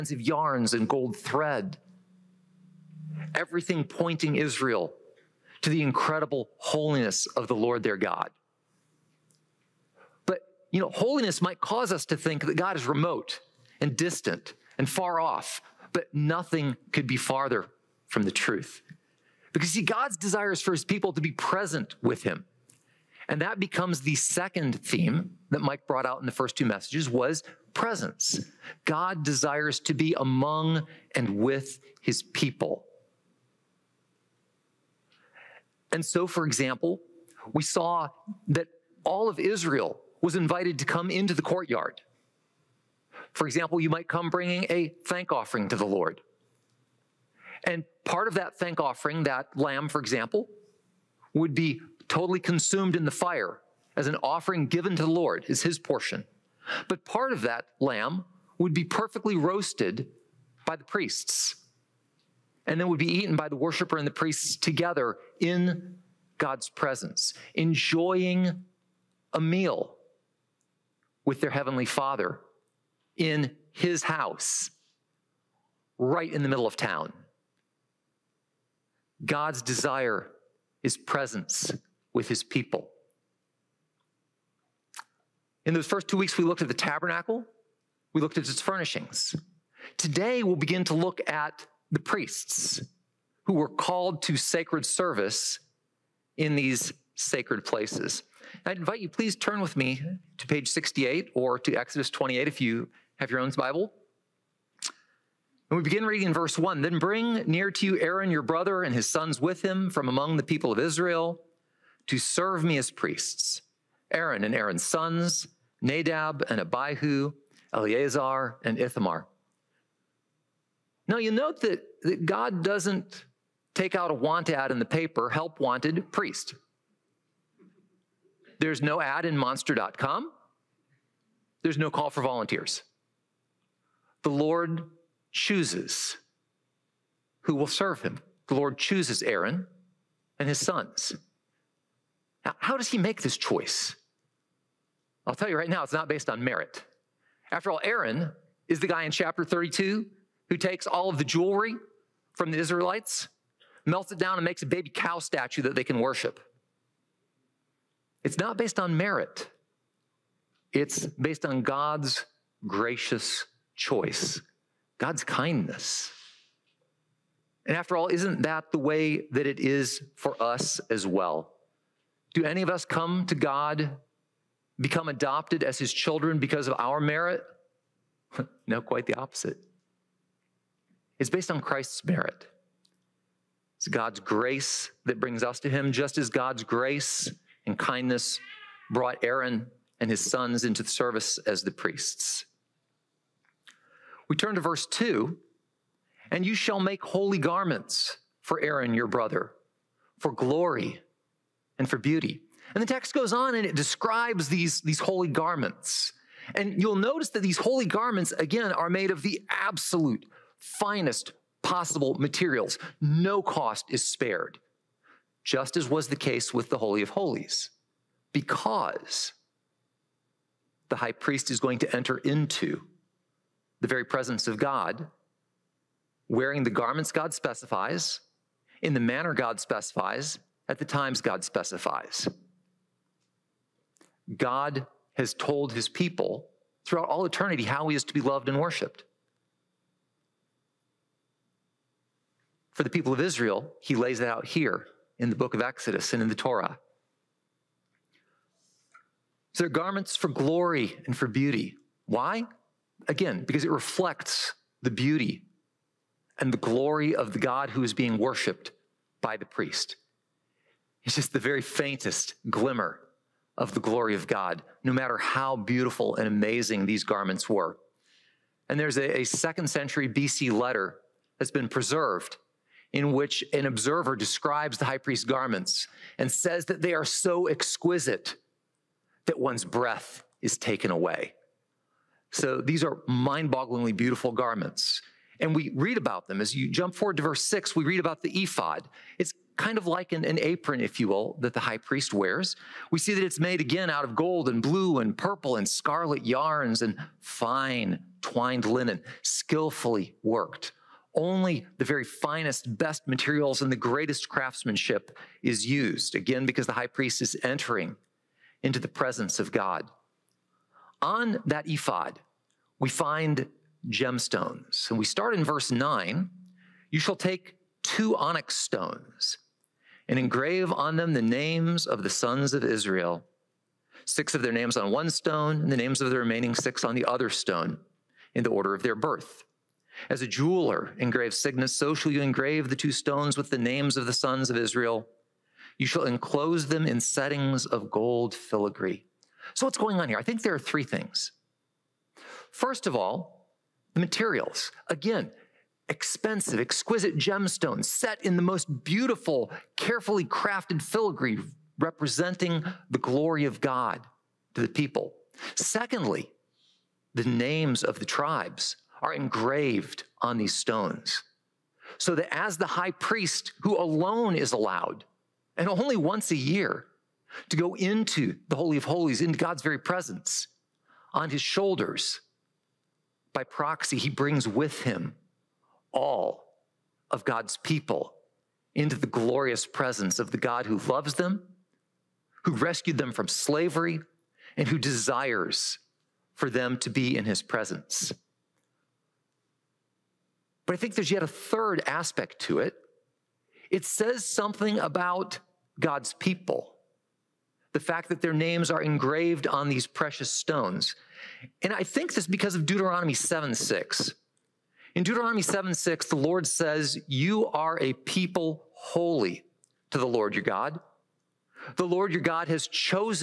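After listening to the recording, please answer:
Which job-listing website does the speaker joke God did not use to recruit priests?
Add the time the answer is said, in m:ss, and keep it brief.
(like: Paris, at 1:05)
monster.com, at 2:09.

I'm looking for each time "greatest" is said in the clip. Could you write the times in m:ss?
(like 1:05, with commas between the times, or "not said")
5:03.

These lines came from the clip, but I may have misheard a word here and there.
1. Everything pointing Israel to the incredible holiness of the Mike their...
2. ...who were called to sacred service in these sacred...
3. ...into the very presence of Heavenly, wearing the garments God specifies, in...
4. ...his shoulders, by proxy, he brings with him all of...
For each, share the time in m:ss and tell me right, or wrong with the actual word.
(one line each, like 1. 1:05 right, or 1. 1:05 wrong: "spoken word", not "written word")
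1. 0:03 wrong: "Lord", not "Mike"
2. 1:33 right
3. 3:42 wrong: "God", not "Heavenly"
4. 6:11 right.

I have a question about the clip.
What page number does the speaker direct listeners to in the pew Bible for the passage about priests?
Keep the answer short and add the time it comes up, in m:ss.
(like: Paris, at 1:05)
68, at 1:40.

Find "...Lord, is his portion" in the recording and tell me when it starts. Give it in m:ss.
0:55.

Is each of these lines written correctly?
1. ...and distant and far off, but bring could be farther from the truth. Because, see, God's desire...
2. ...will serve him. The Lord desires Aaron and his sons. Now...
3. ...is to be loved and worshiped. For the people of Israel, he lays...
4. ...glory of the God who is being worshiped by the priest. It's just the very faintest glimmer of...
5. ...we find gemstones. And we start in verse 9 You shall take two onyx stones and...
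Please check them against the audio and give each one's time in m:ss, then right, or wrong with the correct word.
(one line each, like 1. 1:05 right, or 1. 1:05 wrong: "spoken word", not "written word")
1. 0:13 wrong: "nothing", not "bring"
2. 2:17 wrong: "chooses", not "desires"
3. 3:57 right
4. 4:16 right
5. 5:12 right.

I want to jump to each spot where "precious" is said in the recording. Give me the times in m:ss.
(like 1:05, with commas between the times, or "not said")
6:39.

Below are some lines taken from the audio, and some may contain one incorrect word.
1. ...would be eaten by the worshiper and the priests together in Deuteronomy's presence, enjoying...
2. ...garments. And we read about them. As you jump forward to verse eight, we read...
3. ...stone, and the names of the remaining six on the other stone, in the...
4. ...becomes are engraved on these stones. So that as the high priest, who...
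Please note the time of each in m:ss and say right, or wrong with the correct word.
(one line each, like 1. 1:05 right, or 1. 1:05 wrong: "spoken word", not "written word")
1. 1:02 wrong: "God", not "Deuteronomy"
2. 4:44 wrong: "six", not "eight"
3. 5:25 right
4. 5:58 wrong: "tribes", not "becomes".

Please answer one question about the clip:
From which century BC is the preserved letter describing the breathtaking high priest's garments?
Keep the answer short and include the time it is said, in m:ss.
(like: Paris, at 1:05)
second century BC, at 4:29.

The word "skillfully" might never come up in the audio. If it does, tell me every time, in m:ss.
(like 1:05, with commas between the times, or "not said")
4:59.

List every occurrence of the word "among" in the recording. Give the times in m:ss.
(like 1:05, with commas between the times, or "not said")
0:30, 1:50.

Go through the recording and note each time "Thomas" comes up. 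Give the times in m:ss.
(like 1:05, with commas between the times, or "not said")
not said.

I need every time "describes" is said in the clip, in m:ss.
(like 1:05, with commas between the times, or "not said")
3:23, 4:34.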